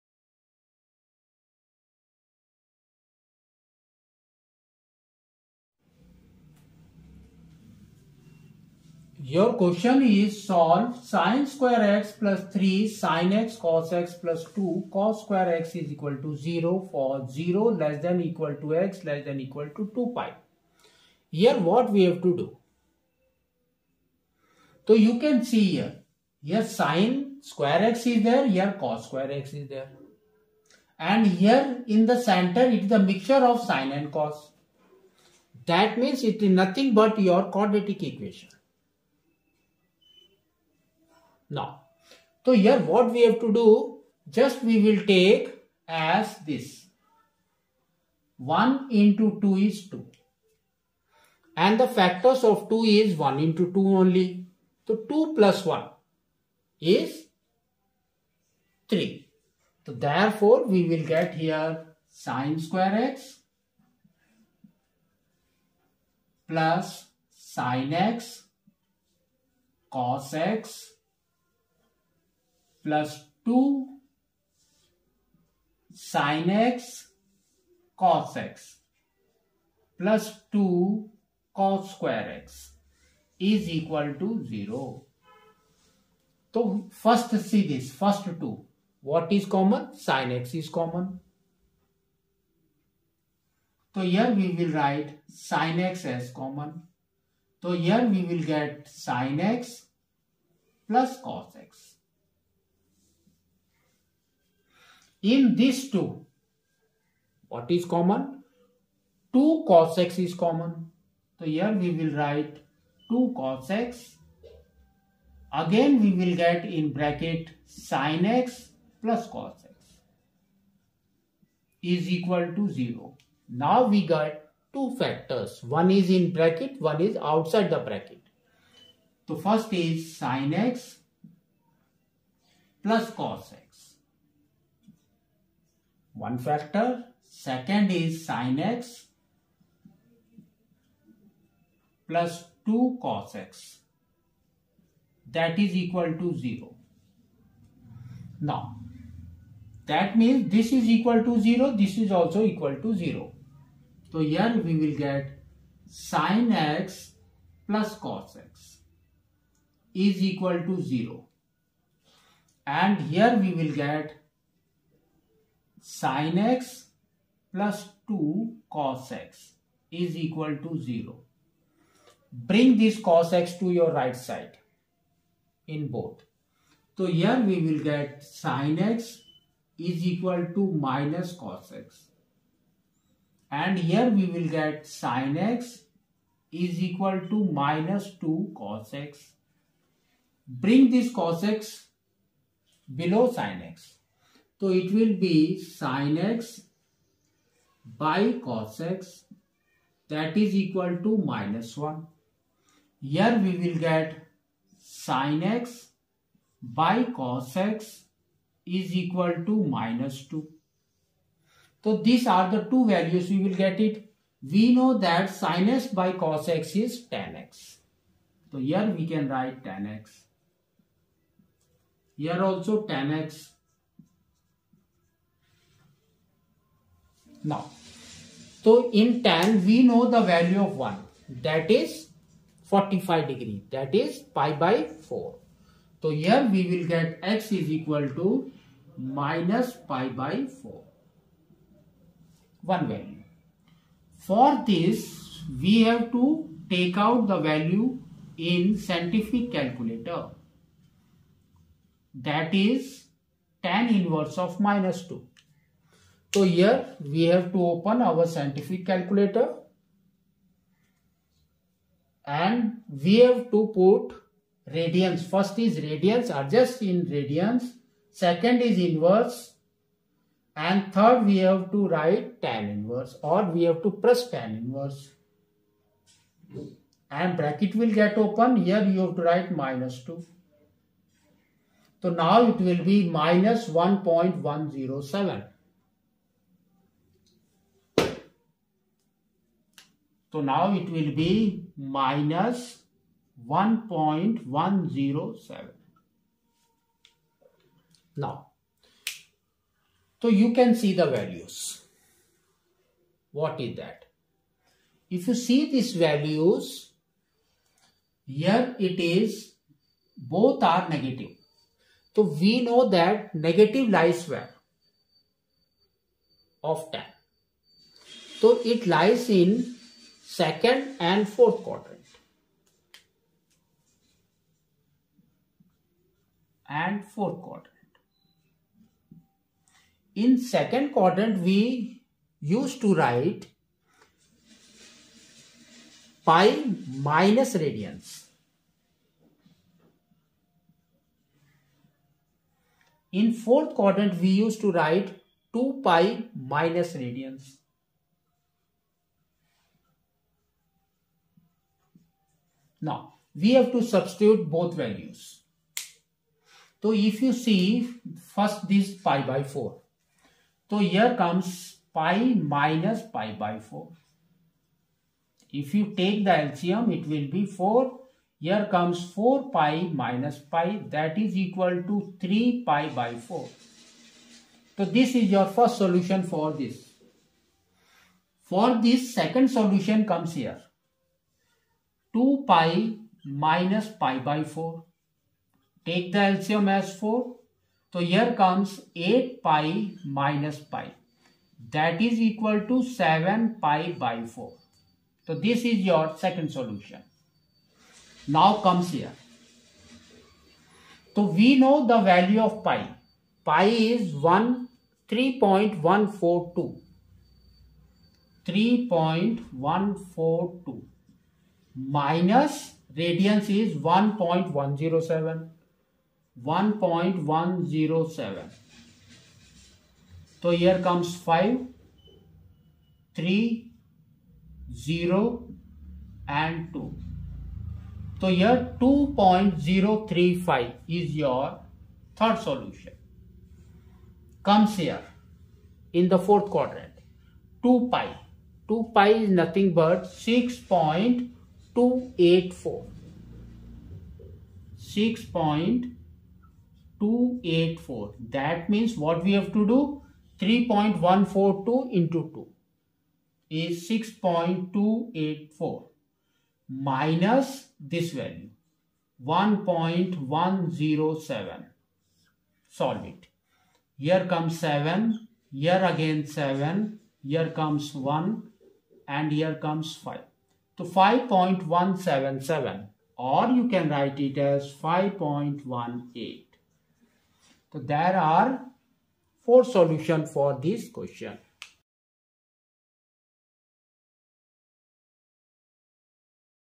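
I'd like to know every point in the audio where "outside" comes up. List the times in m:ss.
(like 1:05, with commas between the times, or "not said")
2:07.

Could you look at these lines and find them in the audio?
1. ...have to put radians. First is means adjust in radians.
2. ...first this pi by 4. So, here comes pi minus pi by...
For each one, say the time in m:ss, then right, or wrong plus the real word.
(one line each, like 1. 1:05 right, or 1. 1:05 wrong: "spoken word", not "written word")
1. 4:23 wrong: "radians", not "means"
2. 5:58 right.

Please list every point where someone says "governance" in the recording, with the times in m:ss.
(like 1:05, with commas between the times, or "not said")
not said.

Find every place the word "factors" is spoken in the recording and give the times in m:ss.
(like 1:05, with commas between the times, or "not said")
0:51, 2:04, 2:16.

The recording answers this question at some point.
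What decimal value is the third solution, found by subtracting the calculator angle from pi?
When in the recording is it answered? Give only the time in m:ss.
7:08.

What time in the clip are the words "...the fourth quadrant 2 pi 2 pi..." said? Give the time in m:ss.
7:16.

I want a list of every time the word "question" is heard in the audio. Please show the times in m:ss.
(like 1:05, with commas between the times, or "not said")
0:09, 8:00.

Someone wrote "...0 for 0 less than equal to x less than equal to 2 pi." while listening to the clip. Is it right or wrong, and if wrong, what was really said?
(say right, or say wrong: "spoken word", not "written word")
right.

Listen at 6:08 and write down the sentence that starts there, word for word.
Here comes 4 pi minus pi that is equal to 3 pi by 4.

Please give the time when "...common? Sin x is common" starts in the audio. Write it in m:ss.
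1:29.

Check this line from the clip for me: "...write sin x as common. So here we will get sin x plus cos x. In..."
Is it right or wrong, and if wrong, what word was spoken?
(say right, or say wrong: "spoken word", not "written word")
right.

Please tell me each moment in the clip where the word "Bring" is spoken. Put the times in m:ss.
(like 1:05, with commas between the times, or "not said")
2:52, 3:10.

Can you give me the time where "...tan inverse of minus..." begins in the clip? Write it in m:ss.
4:13.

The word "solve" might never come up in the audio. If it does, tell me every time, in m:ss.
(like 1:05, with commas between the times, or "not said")
0:10.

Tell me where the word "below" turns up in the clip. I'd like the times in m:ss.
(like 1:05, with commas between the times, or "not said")
3:12.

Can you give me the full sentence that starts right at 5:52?
Now, we have to substitute both values.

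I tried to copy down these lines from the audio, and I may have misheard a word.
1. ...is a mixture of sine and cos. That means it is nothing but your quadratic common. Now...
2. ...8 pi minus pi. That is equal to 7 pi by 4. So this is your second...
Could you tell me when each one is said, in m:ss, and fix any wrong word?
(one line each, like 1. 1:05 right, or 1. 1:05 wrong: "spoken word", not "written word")
1. 0:32 wrong: "equation", not "common"
2. 6:28 right.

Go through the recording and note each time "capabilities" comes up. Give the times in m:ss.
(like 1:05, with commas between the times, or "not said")
not said.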